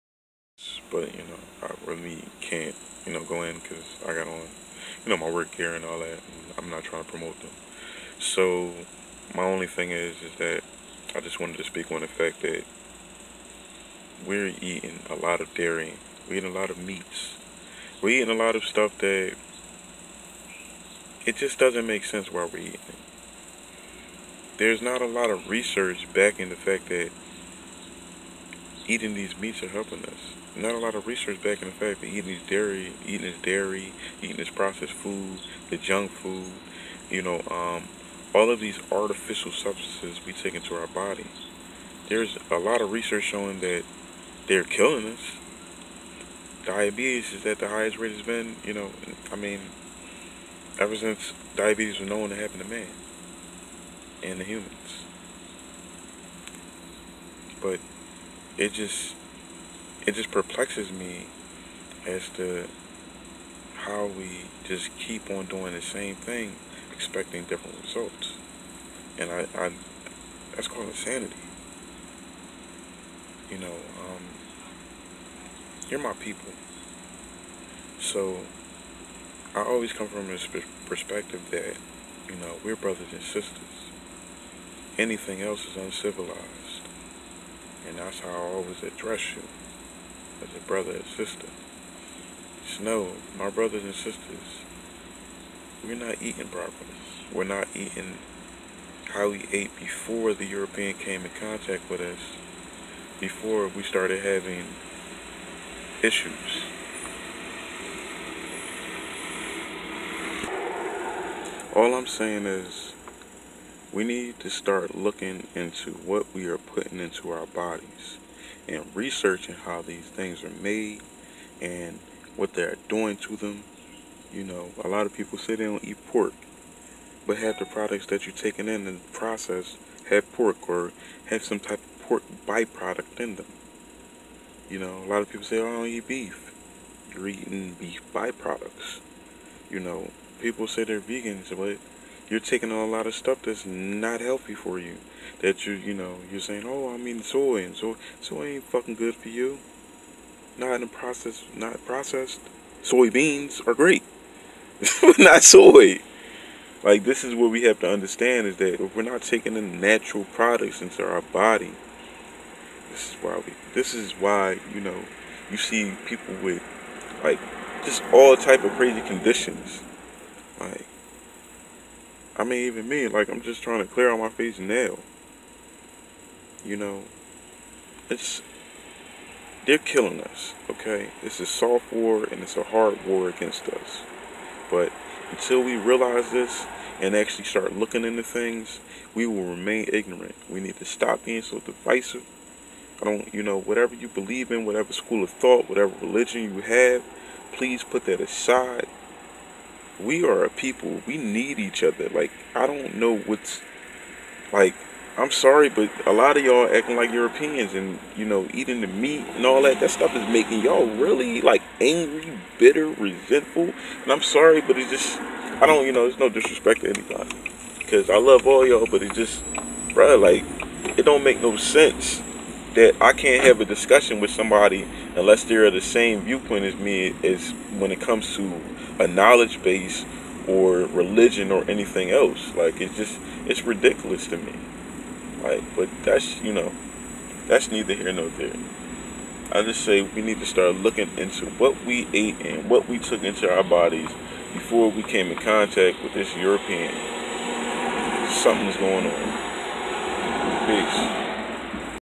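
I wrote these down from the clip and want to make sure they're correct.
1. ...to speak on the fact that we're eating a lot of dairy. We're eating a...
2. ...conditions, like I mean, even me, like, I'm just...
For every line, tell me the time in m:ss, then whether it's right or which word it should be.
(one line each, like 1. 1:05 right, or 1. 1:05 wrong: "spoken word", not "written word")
1. 0:11 right
2. 2:49 right.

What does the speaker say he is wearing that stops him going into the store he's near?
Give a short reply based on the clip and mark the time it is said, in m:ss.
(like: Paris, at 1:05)
work gear, at 0:05.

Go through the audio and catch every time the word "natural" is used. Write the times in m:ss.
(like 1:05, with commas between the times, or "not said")
2:39.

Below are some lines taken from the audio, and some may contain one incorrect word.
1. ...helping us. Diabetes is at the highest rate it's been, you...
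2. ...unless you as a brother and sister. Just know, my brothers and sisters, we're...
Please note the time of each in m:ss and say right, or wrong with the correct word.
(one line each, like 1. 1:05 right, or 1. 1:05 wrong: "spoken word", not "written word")
1. 0:44 wrong: "killing", not "helping"
2. 1:28 wrong: "address", not "unless".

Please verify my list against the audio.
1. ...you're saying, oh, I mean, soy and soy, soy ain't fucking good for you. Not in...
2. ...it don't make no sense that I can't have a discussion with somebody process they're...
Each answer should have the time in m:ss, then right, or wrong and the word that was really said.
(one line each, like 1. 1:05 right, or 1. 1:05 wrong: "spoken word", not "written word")
1. 2:26 right
2. 3:40 wrong: "unless", not "process".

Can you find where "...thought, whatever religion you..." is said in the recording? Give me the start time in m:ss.
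3:15.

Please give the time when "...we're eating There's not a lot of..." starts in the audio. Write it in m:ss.
0:22.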